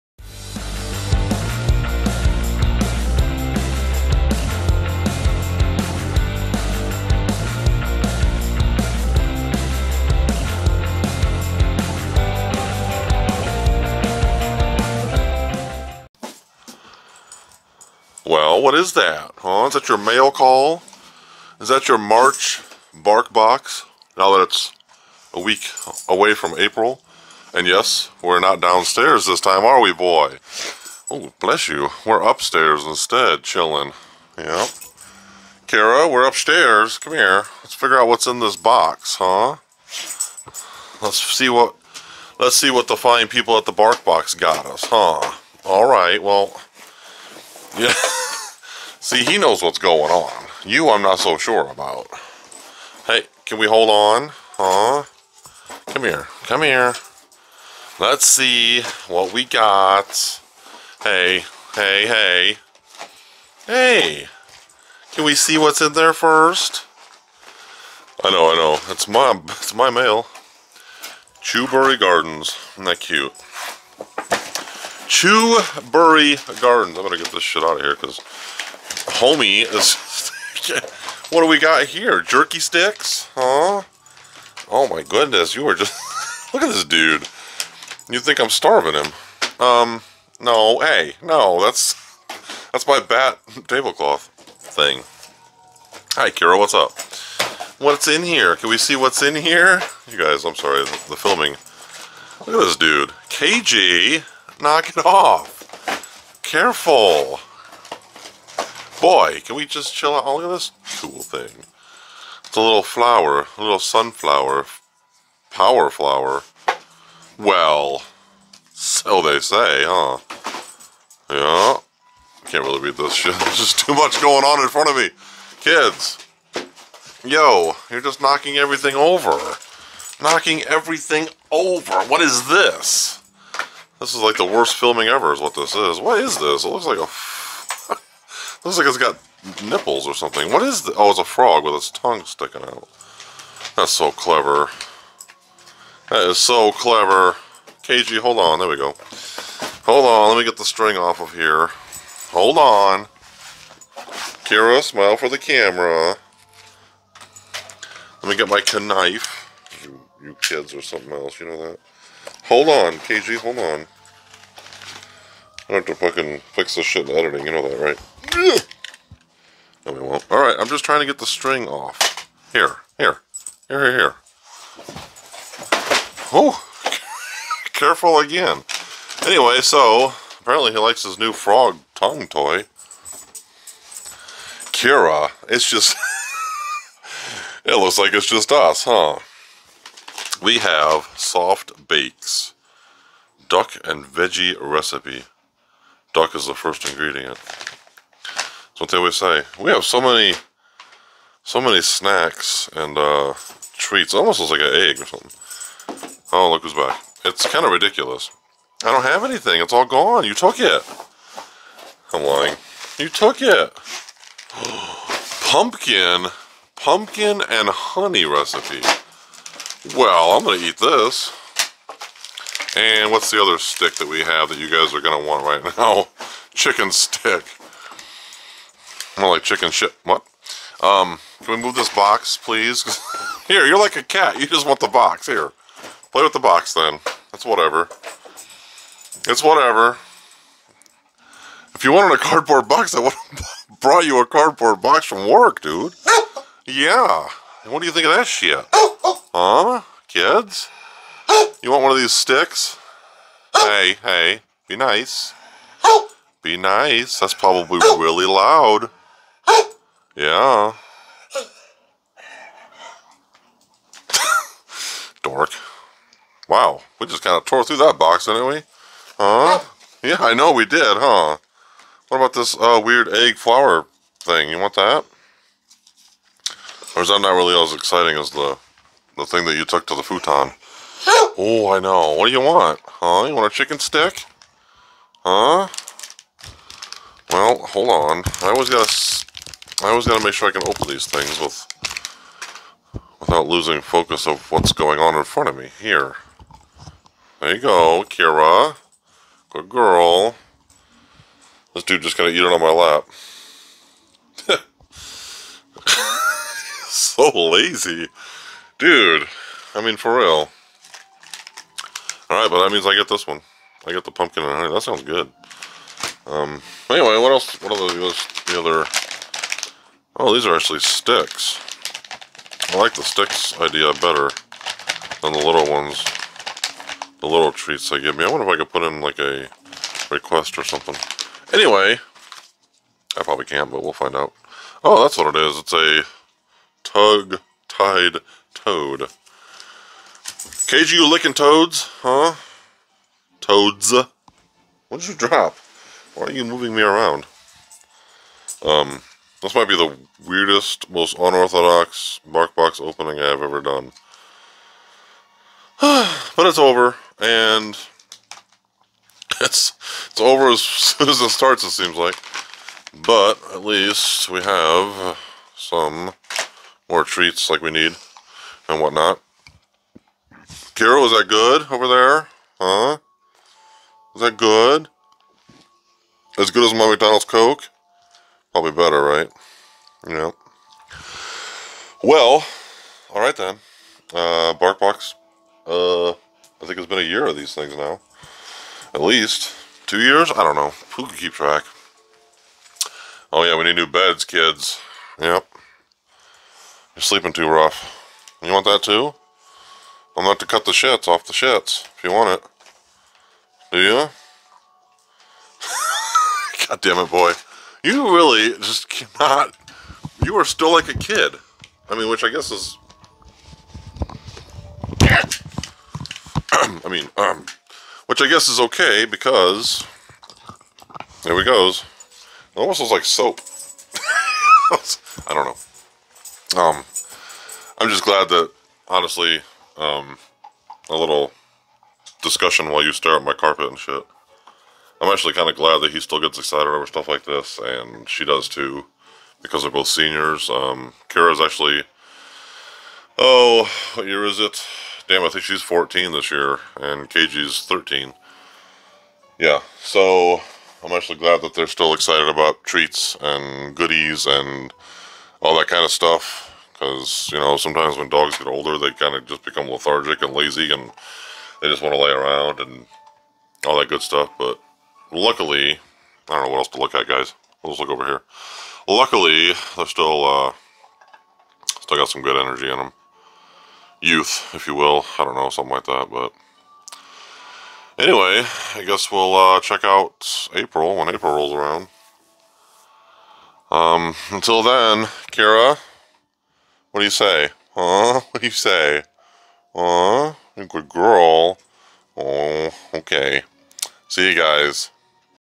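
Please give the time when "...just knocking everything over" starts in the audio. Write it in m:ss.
2:08.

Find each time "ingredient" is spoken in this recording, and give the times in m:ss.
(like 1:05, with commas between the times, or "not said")
3:16.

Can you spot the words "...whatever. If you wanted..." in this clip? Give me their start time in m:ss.
3:59.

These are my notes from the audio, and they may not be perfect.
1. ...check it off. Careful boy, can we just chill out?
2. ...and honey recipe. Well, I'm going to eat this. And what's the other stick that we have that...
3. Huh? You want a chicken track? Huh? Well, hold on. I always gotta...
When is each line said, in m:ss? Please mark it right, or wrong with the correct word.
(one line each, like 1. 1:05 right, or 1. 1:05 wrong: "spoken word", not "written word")
1. 1:44 wrong: "knock", not "check"
2. 3:37 right
3. 4:42 wrong: "stick", not "track".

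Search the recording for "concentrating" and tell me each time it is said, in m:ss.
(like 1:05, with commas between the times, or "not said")
not said.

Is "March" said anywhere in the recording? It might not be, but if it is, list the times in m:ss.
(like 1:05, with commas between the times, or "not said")
0:21.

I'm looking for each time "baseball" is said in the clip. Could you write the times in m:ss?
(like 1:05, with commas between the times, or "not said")
not said.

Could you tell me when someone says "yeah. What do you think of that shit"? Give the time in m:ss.
4:06.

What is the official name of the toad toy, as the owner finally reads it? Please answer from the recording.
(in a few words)
Tug tied toad.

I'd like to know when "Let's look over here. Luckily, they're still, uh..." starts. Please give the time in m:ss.
7:47.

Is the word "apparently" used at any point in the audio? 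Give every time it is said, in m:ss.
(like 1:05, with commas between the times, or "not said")
3:00.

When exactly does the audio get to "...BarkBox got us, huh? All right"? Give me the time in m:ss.
0:43.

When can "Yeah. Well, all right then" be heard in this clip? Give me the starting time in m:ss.
6:20.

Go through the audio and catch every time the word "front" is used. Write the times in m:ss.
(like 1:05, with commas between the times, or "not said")
2:04, 4:55.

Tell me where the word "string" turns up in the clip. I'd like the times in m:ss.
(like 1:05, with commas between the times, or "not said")
2:30, 2:51.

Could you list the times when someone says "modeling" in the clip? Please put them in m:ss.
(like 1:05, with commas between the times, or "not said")
not said.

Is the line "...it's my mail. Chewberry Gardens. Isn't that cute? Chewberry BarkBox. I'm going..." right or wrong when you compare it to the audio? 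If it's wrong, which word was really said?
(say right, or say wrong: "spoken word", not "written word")
wrong: "Gardens", not "BarkBox".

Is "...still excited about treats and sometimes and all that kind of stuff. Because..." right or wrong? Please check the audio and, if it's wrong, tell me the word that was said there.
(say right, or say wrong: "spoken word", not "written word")
wrong: "goodies", not "sometimes".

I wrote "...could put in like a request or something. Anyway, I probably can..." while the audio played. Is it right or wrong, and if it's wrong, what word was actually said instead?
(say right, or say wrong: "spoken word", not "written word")
right.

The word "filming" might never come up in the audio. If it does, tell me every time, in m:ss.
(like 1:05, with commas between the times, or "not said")
1:41, 2:14.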